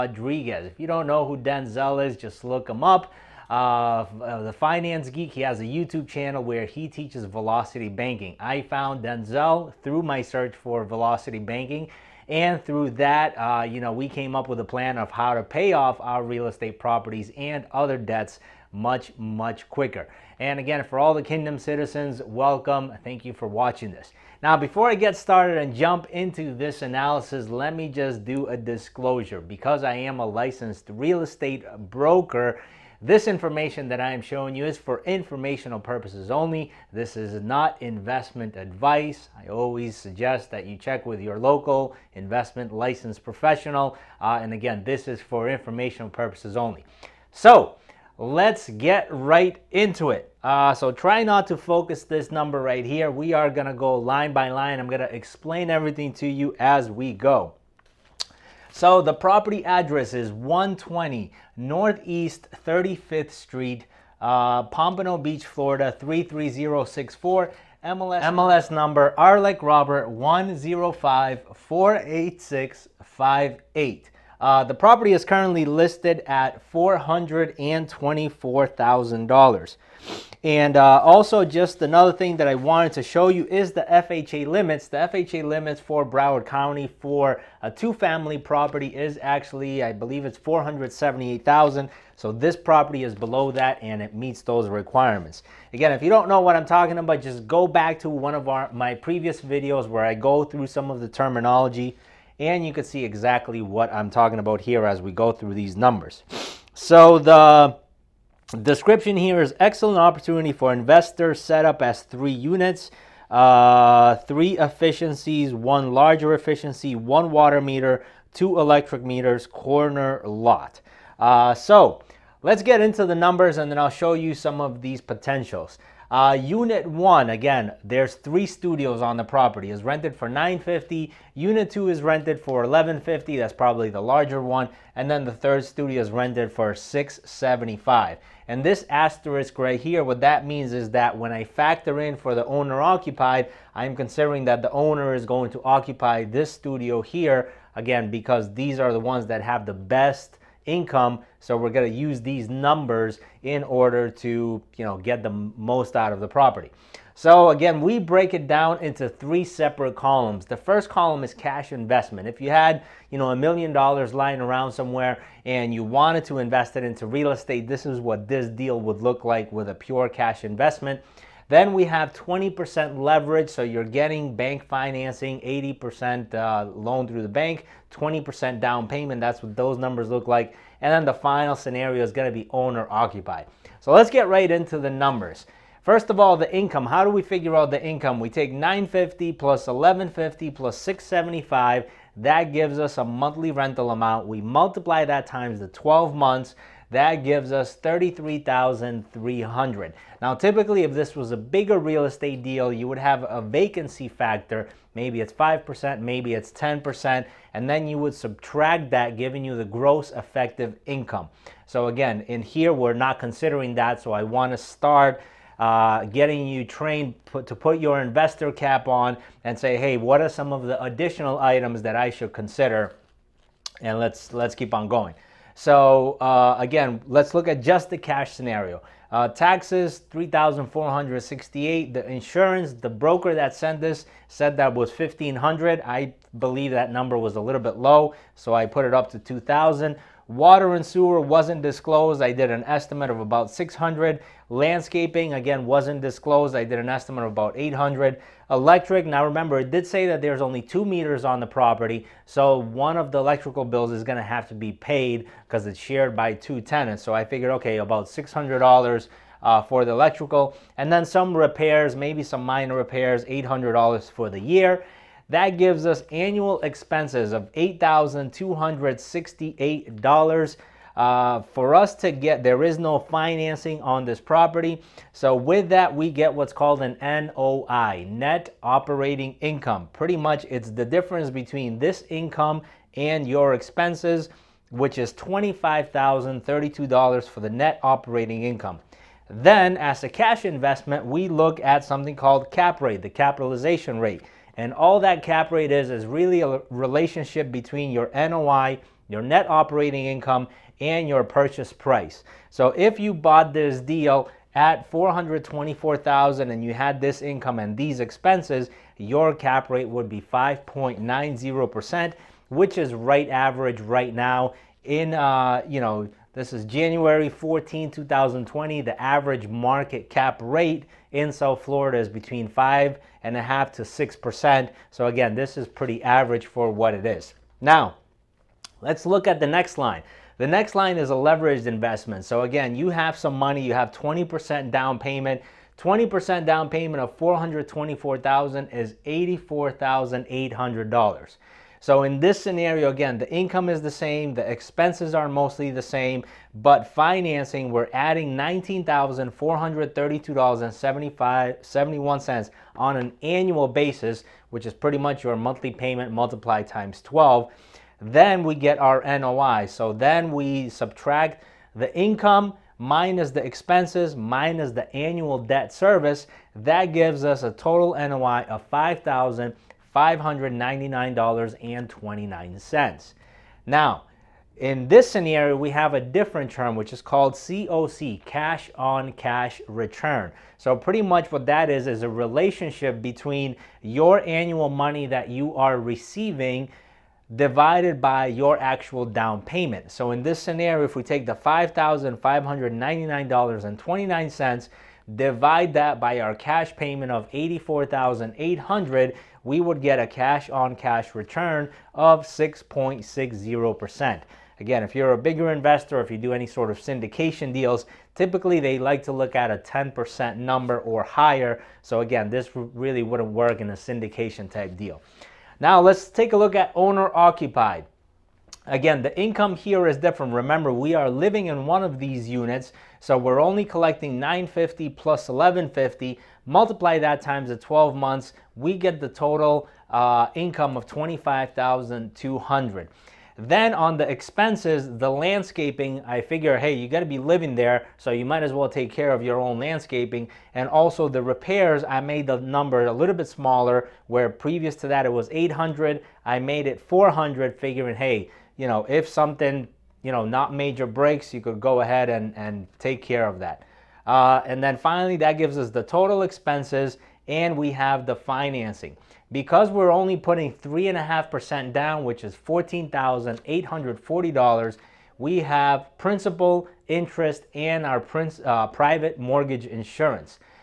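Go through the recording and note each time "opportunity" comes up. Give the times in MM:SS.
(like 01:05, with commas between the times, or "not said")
01:49.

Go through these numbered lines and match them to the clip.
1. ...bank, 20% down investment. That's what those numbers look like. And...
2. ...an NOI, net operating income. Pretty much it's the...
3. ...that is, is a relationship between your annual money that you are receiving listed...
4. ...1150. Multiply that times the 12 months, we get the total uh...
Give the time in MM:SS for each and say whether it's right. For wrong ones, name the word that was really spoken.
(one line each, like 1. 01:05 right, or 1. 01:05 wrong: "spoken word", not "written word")
1. 02:57 wrong: "payment", not "investment"
2. 04:36 right
3. 06:21 wrong: "divided", not "listed"
4. 07:05 right.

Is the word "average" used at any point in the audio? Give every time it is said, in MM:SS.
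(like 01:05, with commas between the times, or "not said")
05:13, 05:19, 05:26.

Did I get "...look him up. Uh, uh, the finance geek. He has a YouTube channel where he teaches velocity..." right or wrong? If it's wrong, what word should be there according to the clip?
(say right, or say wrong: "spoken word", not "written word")
right.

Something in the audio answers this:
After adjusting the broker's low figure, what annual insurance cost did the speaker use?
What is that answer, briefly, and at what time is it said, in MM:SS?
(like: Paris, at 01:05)
2,000, at 03:59.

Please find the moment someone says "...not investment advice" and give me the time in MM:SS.
00:37.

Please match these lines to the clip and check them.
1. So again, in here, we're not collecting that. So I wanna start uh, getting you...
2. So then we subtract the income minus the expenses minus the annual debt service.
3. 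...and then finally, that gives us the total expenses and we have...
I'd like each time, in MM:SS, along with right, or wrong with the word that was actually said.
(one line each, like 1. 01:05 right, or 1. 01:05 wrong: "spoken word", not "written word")
1. 03:31 wrong: "considering", not "collecting"
2. 05:59 right
3. 07:34 right.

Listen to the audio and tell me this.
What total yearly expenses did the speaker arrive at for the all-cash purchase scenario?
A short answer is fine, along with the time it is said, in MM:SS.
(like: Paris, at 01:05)
$8,268, at 04:27.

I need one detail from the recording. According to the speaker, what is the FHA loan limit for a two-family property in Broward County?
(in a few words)
478,000.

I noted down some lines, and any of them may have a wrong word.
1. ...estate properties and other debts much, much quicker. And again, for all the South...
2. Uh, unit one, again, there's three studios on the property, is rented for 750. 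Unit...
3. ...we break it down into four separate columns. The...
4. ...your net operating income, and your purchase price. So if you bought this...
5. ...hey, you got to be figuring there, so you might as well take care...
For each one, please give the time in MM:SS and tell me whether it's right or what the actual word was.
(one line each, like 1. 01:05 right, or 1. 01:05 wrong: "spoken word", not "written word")
1. 00:16 wrong: "Kingdom", not "South"
2. 02:06 wrong: "950", not "750"
3. 02:37 wrong: "three", not "four"
4. 04:59 right
5. 07:16 wrong: "living", not "figuring".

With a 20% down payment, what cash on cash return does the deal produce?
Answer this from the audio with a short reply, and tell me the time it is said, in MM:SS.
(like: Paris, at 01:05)
6.60%, at 06:42.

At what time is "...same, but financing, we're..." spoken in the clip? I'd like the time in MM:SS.
05:45.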